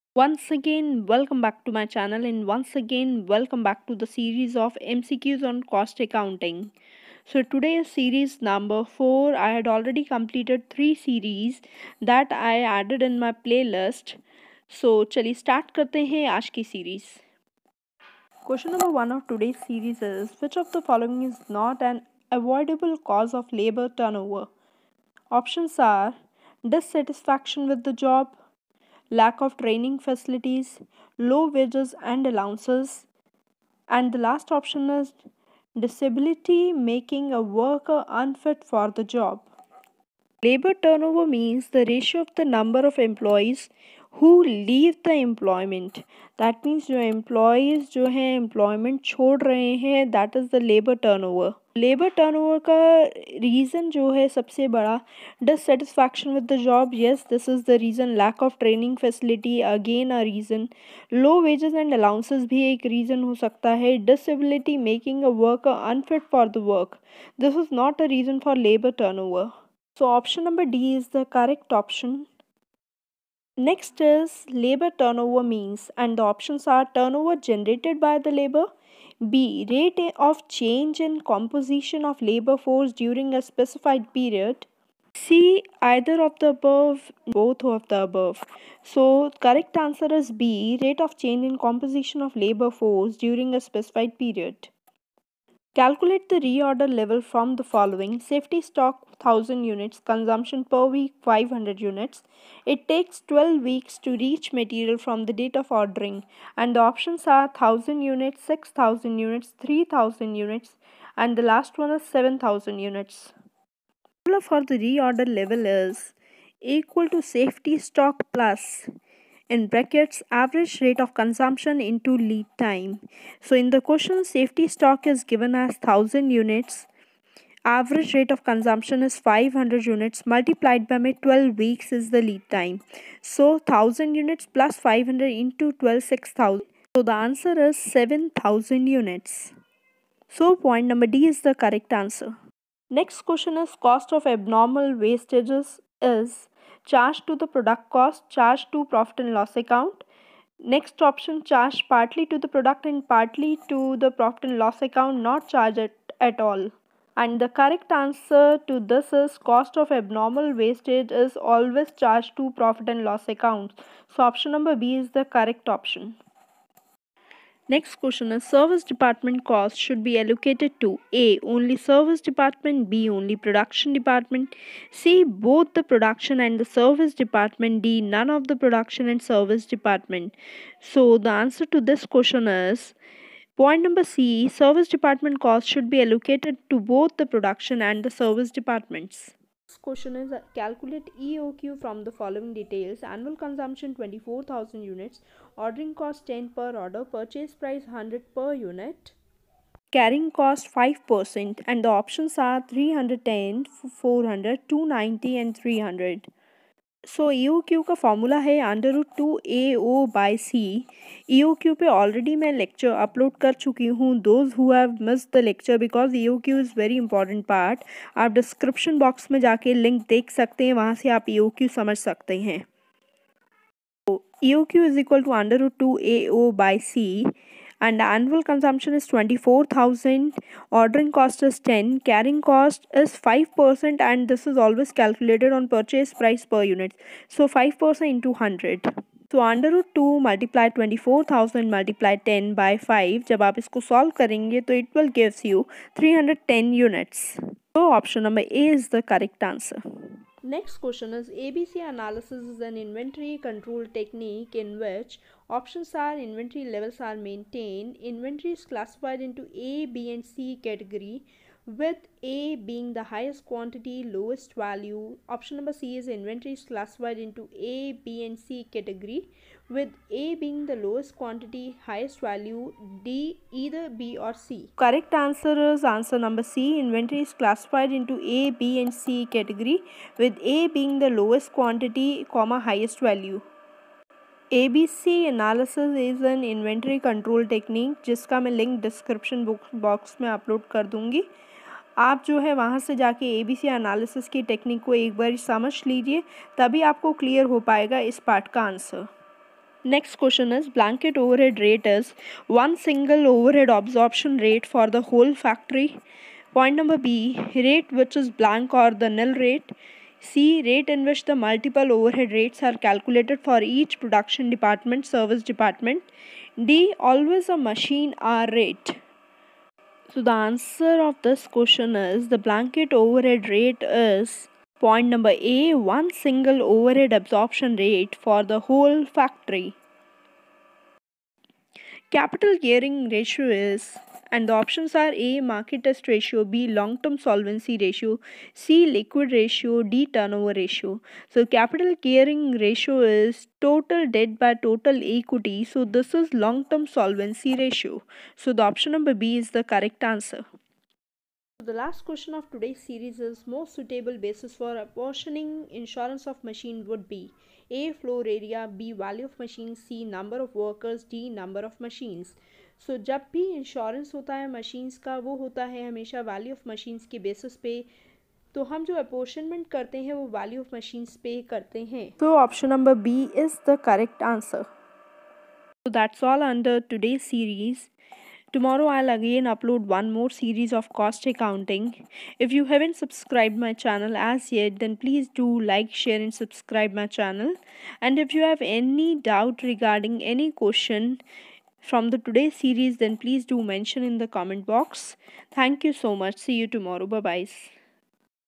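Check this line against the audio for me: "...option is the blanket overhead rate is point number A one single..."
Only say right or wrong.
wrong.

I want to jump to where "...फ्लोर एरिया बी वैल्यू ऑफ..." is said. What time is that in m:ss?
5:58.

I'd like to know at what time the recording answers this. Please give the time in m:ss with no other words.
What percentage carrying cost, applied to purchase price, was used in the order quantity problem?
3:19.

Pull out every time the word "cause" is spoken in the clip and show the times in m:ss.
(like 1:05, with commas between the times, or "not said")
0:22.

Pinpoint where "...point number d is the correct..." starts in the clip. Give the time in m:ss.
2:20.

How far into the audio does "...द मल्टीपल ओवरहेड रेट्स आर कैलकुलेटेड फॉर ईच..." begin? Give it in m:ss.
5:11.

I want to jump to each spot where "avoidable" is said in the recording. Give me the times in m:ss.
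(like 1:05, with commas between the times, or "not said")
0:22.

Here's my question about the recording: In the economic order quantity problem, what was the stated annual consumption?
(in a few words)
24,000 units.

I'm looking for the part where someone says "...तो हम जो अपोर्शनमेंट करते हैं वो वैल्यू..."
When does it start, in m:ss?
6:08.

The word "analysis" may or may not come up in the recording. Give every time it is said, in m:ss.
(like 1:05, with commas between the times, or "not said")
4:11, 4:45.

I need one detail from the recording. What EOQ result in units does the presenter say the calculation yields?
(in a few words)
310.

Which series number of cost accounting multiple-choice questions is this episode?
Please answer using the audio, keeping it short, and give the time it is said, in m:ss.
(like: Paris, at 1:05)
4, at 0:07.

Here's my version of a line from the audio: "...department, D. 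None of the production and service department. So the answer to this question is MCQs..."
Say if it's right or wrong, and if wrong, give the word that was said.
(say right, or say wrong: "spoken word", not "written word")
wrong: "Point", not "MCQs".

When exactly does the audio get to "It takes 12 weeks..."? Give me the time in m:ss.
1:42.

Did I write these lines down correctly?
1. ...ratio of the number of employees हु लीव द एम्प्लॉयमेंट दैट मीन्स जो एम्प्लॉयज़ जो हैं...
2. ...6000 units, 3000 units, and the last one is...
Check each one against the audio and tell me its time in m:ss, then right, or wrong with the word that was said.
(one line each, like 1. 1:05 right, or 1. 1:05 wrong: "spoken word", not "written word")
1. 0:41 right
2. 1:48 right.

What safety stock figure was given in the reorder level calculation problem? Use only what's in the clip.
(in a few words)
1000 units.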